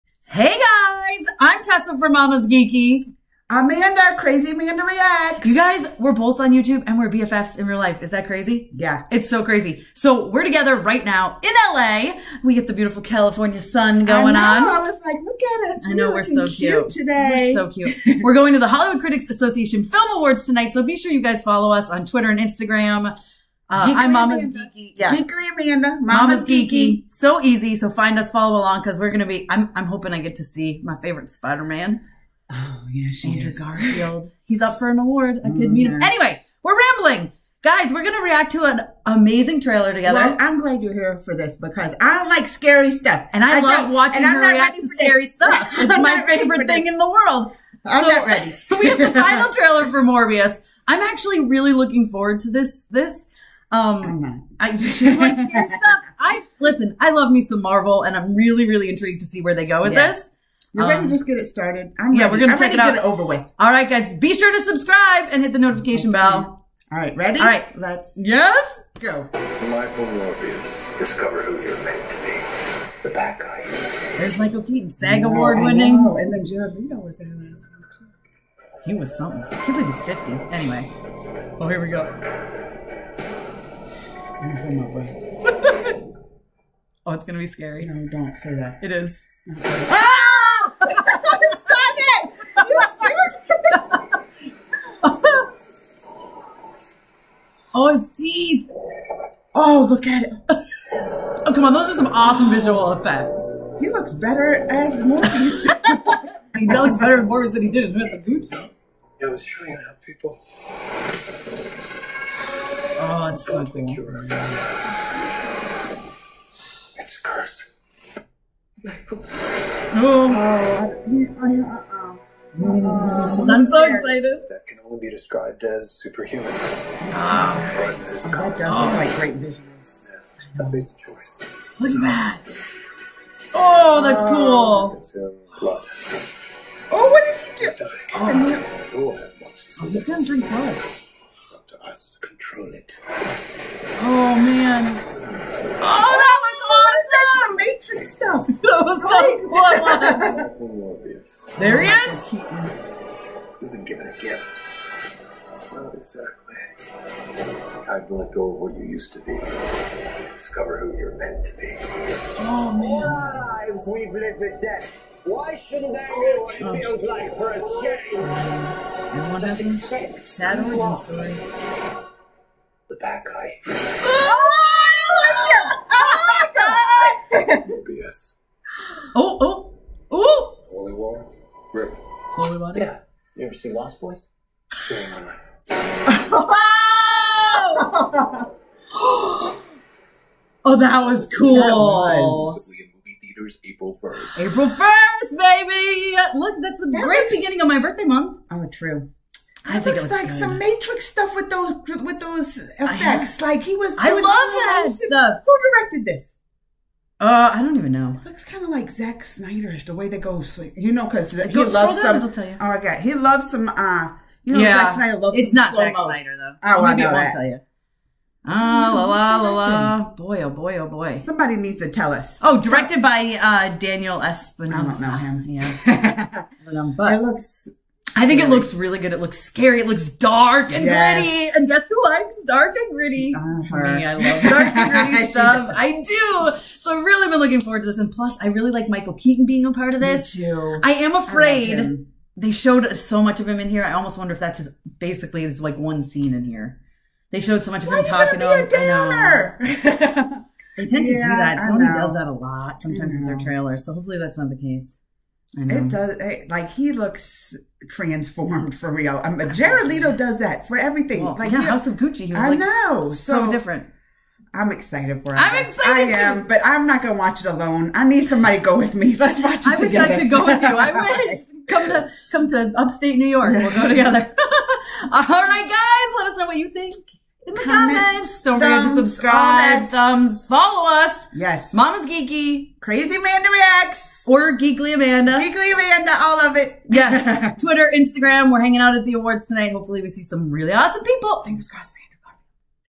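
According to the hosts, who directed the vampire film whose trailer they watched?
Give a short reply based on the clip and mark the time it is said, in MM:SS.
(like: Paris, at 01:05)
Daniel Espinosa, at 03:43.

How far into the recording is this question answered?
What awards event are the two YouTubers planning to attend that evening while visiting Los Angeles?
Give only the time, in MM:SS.
00:18.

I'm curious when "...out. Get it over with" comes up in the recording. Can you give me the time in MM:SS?
01:02.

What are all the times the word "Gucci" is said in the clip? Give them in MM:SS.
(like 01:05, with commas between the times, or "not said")
01:48, 04:21.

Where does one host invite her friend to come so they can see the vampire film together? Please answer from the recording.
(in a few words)
upstate New York.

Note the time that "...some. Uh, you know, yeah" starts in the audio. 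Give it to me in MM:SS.
03:33.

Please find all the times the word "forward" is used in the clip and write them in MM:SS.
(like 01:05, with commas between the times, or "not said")
00:52, 03:57.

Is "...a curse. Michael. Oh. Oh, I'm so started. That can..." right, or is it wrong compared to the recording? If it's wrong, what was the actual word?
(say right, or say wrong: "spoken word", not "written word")
wrong: "excited", not "started".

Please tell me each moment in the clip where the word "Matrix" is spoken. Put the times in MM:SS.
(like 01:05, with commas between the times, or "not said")
02:27, 03:20.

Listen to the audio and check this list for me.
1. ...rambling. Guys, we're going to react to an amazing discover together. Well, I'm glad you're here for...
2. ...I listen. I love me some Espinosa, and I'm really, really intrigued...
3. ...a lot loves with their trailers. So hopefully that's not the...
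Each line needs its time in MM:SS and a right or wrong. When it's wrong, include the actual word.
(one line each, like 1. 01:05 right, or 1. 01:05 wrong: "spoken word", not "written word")
1. 00:36 wrong: "trailer", not "discover"
2. 00:56 wrong: "Marvel", not "Espinosa"
3. 04:12 wrong: "sometimes", not "loves".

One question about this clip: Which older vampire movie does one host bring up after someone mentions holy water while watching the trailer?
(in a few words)
Lost Boys.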